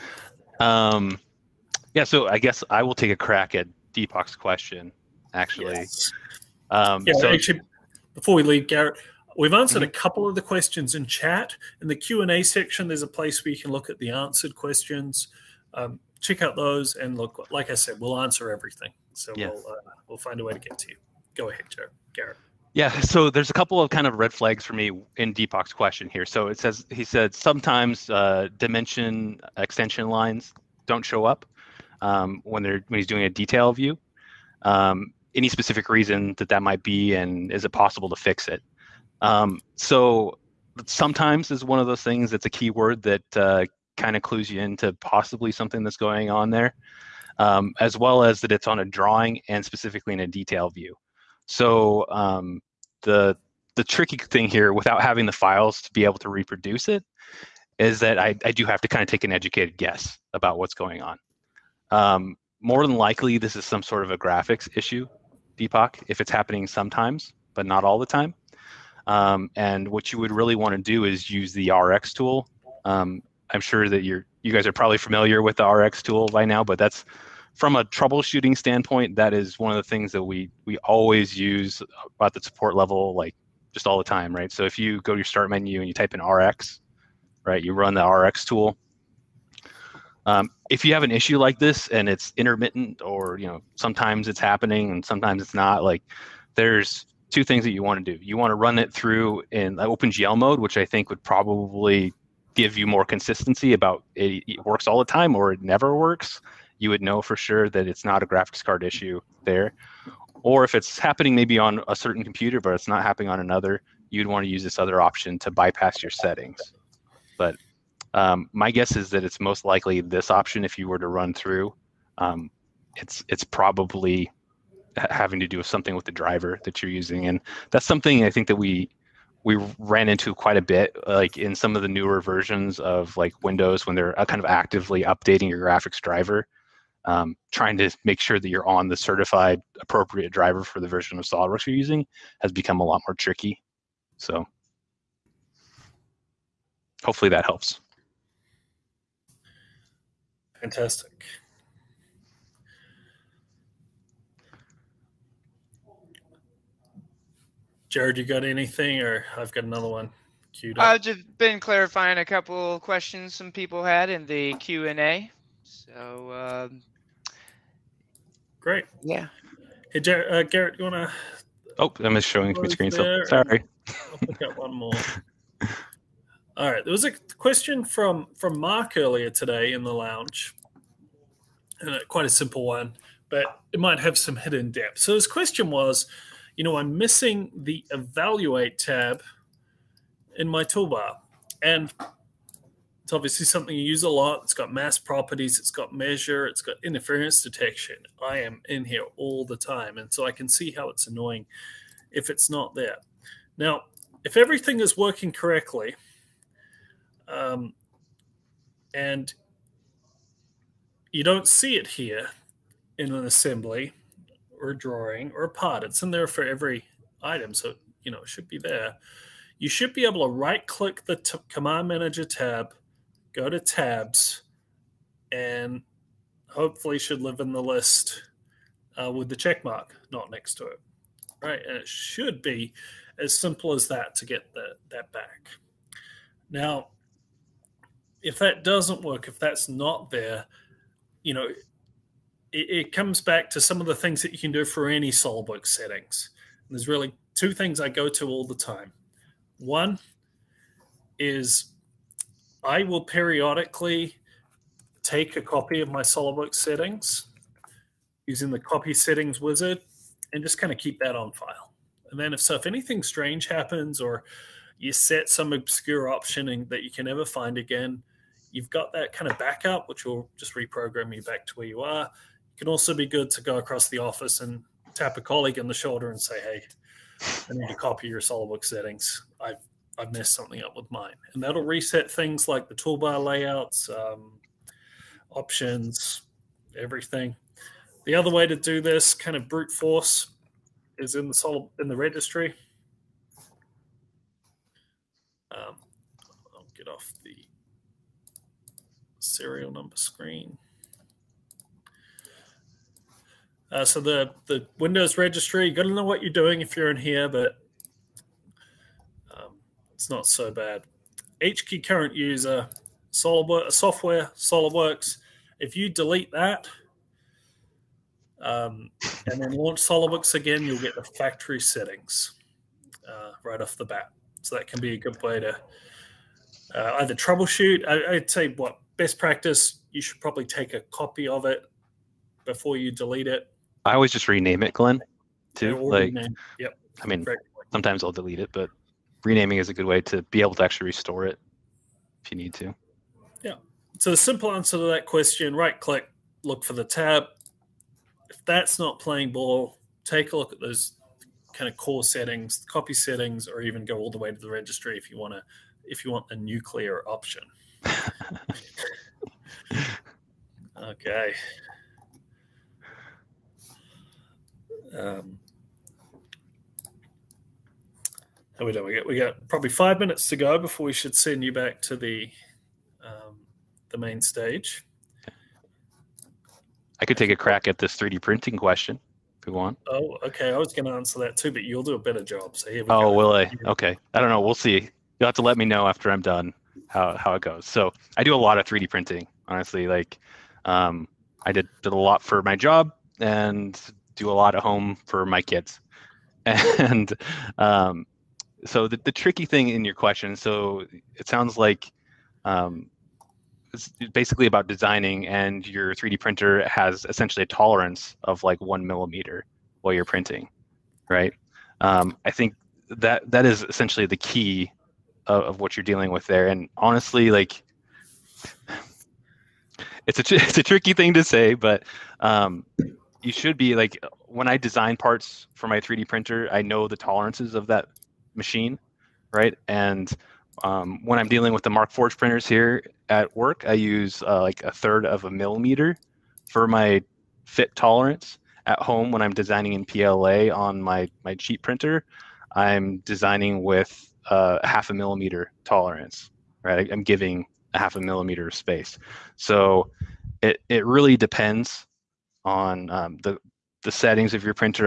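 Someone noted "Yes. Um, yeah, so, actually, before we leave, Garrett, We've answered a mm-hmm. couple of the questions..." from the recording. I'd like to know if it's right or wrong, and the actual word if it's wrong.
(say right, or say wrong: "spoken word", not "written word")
right.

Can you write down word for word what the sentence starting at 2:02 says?
Um, it's it's probably having to do with something with the driver that you're using.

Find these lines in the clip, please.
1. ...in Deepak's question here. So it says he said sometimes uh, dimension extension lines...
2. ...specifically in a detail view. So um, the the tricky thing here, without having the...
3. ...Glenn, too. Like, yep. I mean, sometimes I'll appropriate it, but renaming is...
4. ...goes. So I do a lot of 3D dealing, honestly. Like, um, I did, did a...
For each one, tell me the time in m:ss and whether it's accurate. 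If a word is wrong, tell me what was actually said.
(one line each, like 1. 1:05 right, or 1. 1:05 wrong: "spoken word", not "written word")
1. 0:25 right
2. 0:49 right
3. 5:34 wrong: "delete", not "appropriate"
4. 6:27 wrong: "printing", not "dealing".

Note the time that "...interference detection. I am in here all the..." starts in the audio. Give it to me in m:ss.
3:16.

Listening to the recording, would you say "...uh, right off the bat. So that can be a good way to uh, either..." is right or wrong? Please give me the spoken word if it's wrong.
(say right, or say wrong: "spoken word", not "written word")
right.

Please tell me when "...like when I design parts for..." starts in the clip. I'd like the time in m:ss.
7:03.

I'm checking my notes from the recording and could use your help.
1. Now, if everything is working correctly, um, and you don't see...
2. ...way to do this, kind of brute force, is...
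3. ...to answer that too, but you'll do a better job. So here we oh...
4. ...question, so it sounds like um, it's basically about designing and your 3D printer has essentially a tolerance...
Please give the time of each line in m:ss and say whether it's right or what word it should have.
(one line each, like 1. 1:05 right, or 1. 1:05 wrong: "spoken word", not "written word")
1. 3:23 right
2. 4:48 right
3. 6:20 right
4. 6:39 right.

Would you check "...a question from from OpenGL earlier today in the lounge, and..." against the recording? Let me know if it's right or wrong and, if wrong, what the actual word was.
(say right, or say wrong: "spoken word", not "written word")
wrong: "Mark", not "OpenGL".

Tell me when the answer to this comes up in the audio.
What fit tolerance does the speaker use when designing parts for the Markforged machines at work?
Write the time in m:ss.
7:14.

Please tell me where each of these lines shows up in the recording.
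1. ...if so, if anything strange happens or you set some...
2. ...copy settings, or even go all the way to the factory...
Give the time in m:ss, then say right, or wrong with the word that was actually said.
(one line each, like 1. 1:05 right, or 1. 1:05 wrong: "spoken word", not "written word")
1. 4:22 right
2. 5:52 wrong: "registry", not "factory".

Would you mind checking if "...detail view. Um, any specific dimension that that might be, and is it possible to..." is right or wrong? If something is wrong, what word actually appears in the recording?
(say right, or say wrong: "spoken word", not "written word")
wrong: "reason", not "dimension".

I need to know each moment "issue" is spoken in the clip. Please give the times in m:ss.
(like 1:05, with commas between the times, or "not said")
1:04, 1:31, 1:48.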